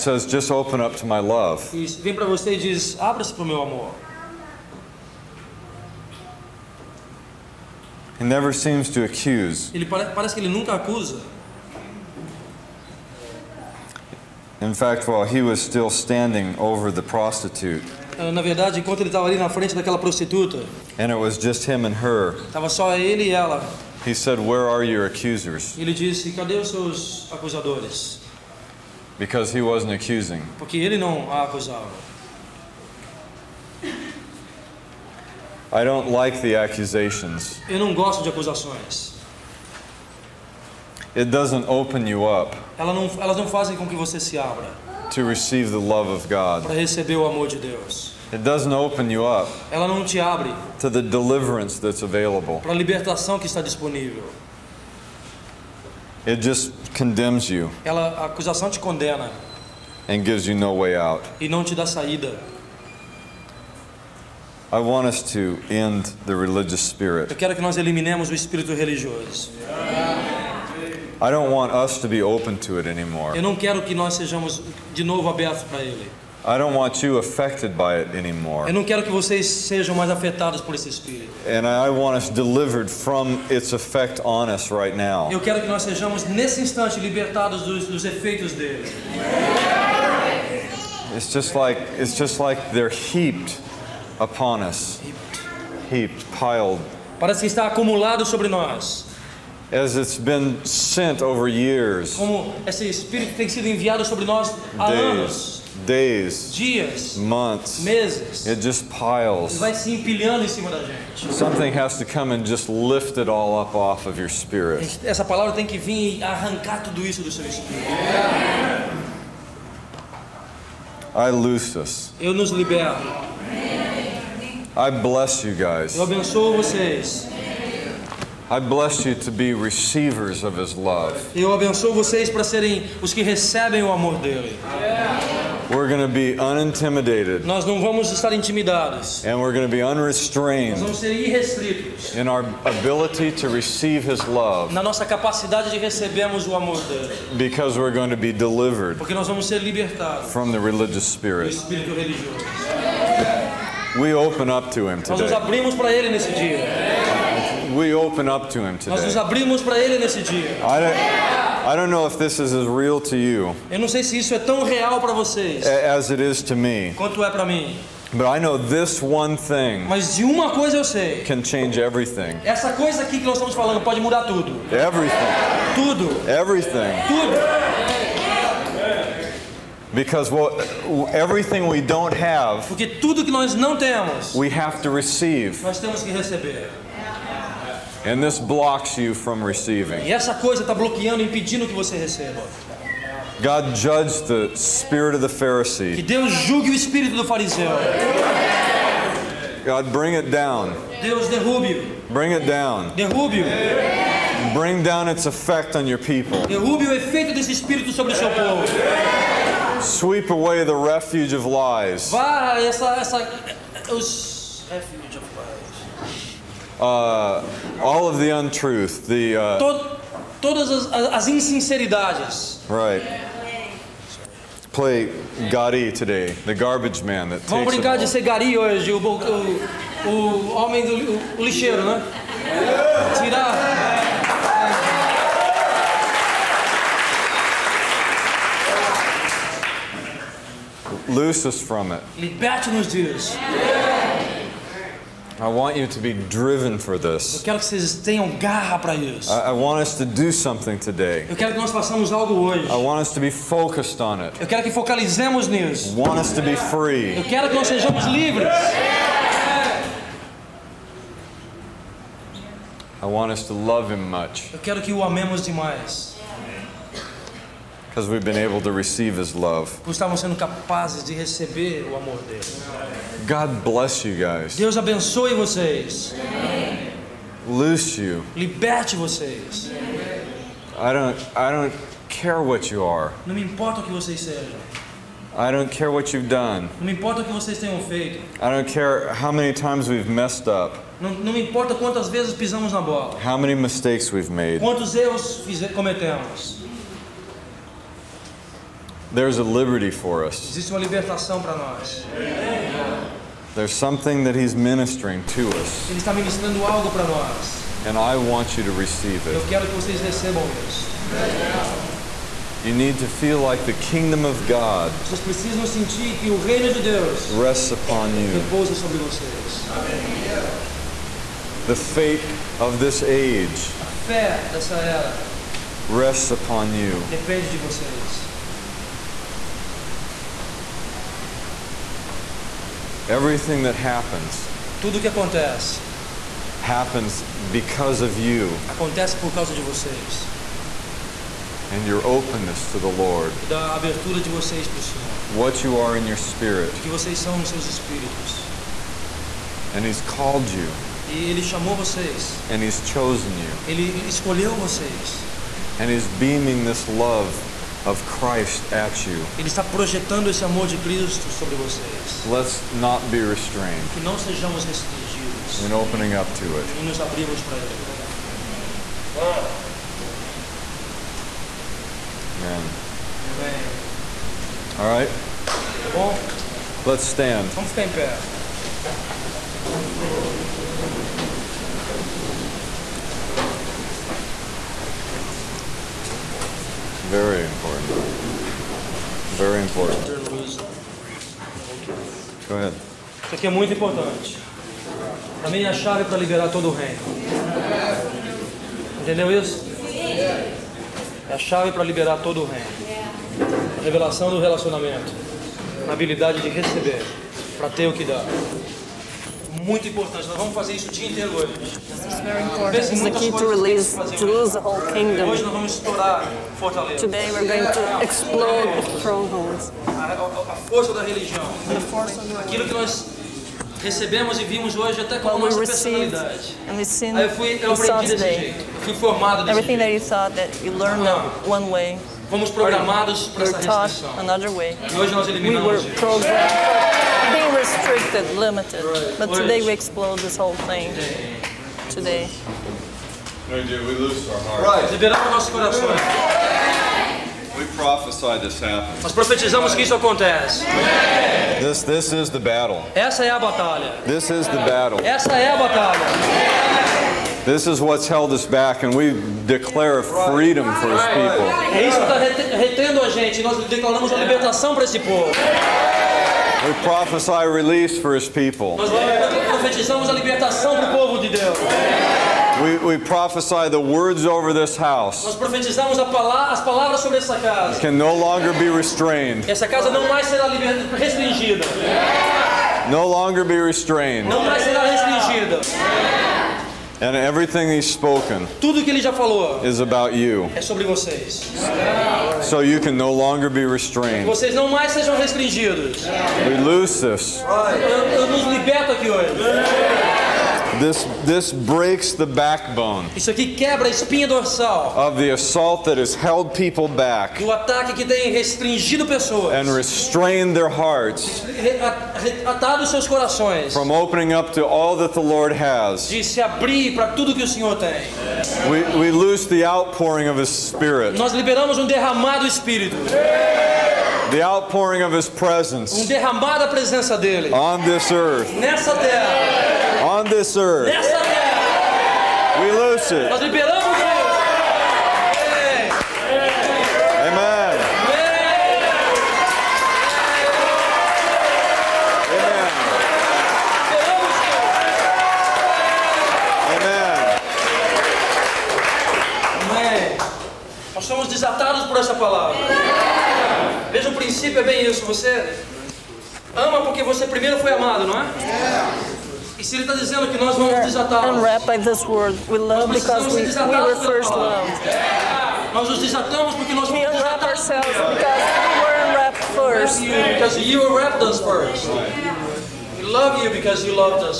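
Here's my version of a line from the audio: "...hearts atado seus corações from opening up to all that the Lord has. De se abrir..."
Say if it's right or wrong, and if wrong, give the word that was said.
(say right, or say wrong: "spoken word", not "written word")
right.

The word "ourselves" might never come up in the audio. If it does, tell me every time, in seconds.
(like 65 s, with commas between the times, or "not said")
567 s.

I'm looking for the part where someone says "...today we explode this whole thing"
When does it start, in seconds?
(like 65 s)
439 s.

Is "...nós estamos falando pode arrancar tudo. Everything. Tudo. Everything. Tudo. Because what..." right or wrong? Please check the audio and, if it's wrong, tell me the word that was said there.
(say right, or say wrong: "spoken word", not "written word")
wrong: "mudar", not "arrancar".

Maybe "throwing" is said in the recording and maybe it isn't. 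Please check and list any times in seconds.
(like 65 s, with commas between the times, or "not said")
not said.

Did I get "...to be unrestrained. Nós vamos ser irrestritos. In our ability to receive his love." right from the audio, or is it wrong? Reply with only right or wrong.
right.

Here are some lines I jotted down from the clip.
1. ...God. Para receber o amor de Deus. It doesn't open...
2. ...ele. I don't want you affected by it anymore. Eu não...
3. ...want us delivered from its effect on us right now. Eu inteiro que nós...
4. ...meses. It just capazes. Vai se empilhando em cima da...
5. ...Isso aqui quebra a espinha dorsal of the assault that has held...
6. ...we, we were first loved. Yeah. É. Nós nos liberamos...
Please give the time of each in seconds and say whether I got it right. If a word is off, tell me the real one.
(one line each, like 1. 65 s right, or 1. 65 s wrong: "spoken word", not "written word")
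1. 46 s right
2. 75 s right
3. 81 s wrong: "quero", not "inteiro"
4. 107 s wrong: "piles", not "capazes"
5. 503 s right
6. 563 s wrong: "desatamos", not "liberamos".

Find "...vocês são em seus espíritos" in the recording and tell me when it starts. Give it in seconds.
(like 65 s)
346 s.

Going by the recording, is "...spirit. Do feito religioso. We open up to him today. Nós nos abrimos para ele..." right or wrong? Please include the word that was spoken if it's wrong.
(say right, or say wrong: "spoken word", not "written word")
wrong: "espírito", not "feito".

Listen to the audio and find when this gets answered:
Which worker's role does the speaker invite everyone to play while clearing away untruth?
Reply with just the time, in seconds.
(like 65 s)
226 s.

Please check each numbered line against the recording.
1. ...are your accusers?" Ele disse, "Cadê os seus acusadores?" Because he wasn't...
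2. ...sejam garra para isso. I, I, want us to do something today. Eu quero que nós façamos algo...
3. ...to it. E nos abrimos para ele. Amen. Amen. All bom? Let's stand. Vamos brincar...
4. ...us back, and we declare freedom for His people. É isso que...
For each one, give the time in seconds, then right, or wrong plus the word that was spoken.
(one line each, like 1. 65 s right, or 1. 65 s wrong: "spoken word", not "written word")
1. 24 s right
2. 247 s wrong: "tenham", not "sejam"
3. 366 s wrong: "ficar", not "brincar"
4. 458 s right.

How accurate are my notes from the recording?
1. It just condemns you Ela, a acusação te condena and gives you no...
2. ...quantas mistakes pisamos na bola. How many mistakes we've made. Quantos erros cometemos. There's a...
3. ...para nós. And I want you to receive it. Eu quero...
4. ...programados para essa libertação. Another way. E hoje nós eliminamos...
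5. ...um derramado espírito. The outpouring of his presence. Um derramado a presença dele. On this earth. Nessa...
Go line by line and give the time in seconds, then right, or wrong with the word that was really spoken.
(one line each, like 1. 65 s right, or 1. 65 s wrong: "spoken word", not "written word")
1. 56 s right
2. 291 s wrong: "vezes", not "mistakes"
3. 306 s right
4. 432 s wrong: "restrição", not "libertação"
5. 521 s right.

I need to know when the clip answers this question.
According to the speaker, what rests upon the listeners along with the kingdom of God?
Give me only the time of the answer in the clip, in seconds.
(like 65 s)
321 s.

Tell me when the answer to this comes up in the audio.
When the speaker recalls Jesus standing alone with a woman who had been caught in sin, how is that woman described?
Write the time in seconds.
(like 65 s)
17 s.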